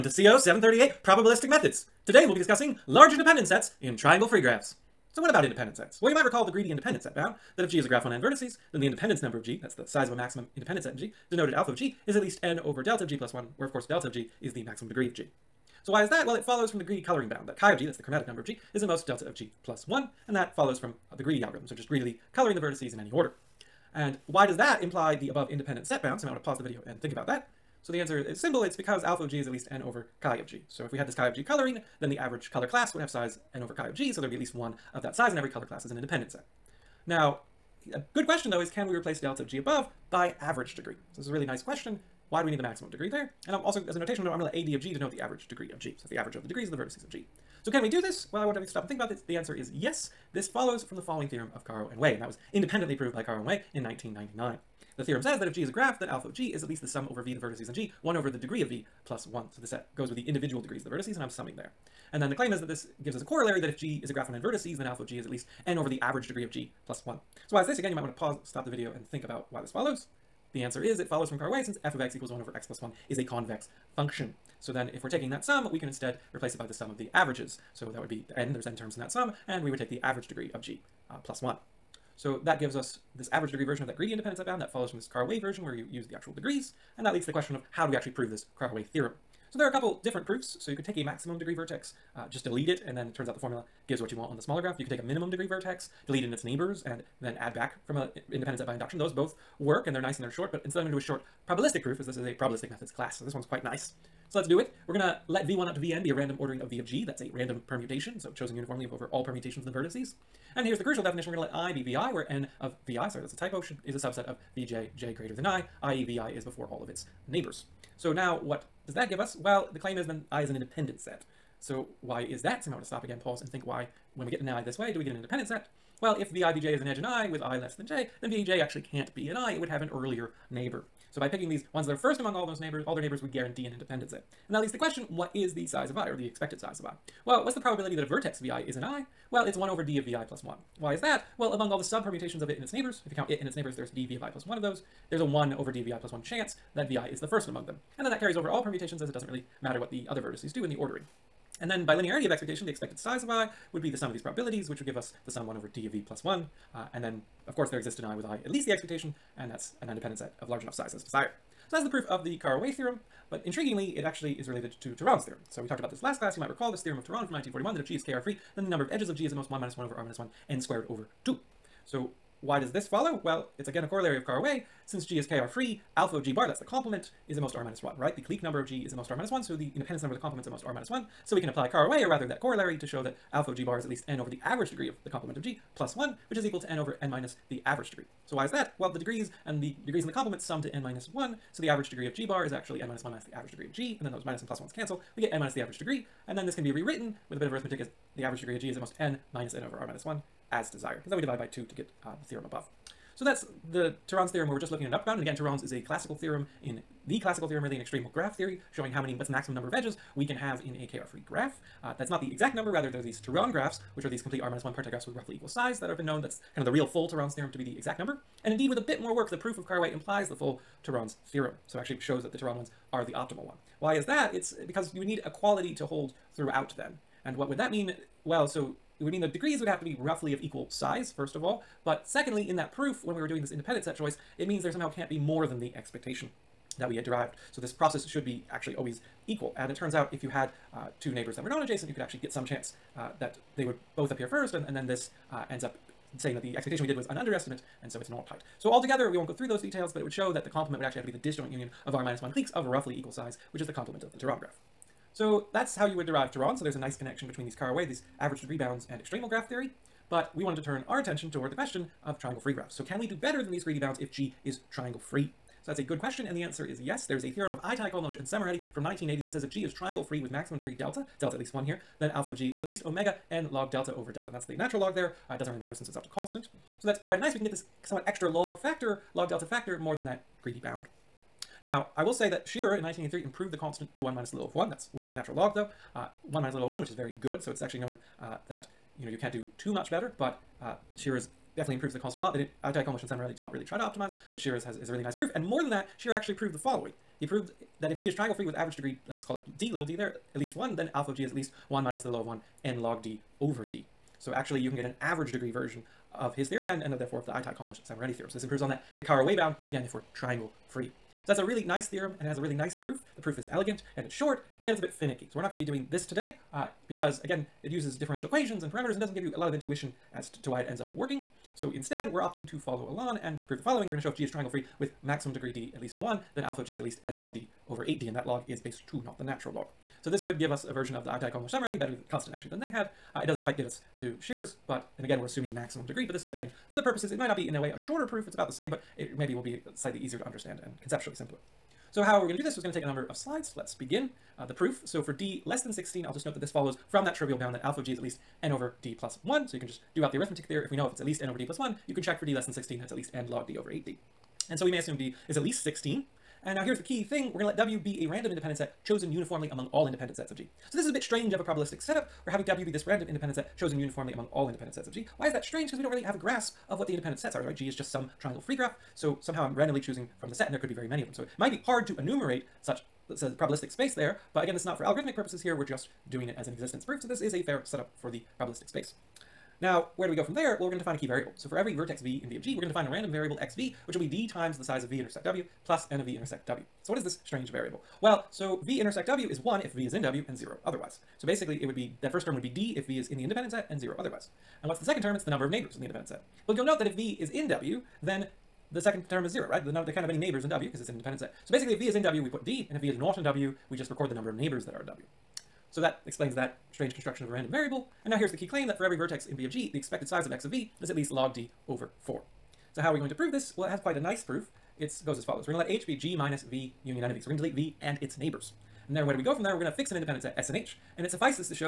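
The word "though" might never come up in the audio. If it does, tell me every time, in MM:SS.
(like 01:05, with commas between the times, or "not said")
00:38, 04:45.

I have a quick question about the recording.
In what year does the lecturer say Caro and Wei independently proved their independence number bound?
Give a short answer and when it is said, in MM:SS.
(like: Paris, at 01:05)
1999, at 00:53.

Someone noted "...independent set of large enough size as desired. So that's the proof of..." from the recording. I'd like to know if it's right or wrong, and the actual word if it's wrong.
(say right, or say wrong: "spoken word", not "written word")
right.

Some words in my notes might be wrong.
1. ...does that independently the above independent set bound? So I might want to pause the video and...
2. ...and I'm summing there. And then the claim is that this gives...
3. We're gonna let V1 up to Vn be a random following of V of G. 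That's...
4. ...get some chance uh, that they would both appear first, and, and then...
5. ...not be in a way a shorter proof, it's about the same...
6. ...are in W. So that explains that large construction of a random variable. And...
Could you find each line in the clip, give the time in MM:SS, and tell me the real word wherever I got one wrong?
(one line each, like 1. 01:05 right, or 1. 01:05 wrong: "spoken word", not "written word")
1. 00:24 wrong: "imply", not "independently"
2. 01:01 right
3. 01:44 wrong: "ordering", not "following"
4. 04:02 right
5. 05:37 right
6. 06:44 wrong: "strange", not "large".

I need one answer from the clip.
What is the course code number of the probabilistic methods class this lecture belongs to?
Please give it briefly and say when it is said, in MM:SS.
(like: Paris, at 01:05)
738, at 00:00.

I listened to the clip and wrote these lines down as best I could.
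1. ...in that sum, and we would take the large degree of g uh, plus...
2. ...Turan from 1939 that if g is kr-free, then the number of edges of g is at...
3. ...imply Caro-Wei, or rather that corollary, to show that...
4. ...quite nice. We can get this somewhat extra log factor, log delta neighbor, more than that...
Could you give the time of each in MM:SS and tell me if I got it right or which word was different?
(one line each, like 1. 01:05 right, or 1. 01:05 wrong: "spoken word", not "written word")
1. 01:18 wrong: "average", not "large"
2. 02:47 wrong: "1941", not "1939"
3. 03:01 wrong: "apply", not "imply"
4. 04:37 wrong: "factor", not "neighbor".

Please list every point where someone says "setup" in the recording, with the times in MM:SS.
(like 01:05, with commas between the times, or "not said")
06:01, 06:17.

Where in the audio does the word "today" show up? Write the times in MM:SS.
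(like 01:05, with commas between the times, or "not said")
00:02, 05:16.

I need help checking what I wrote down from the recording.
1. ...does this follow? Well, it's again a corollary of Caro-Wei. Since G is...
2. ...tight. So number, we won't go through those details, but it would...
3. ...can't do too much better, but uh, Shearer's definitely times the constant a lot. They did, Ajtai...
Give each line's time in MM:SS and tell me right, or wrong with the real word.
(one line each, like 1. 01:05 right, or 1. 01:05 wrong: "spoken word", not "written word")
1. 02:52 right
2. 04:08 wrong: "altogether", not "number"
3. 04:49 wrong: "improves", not "times".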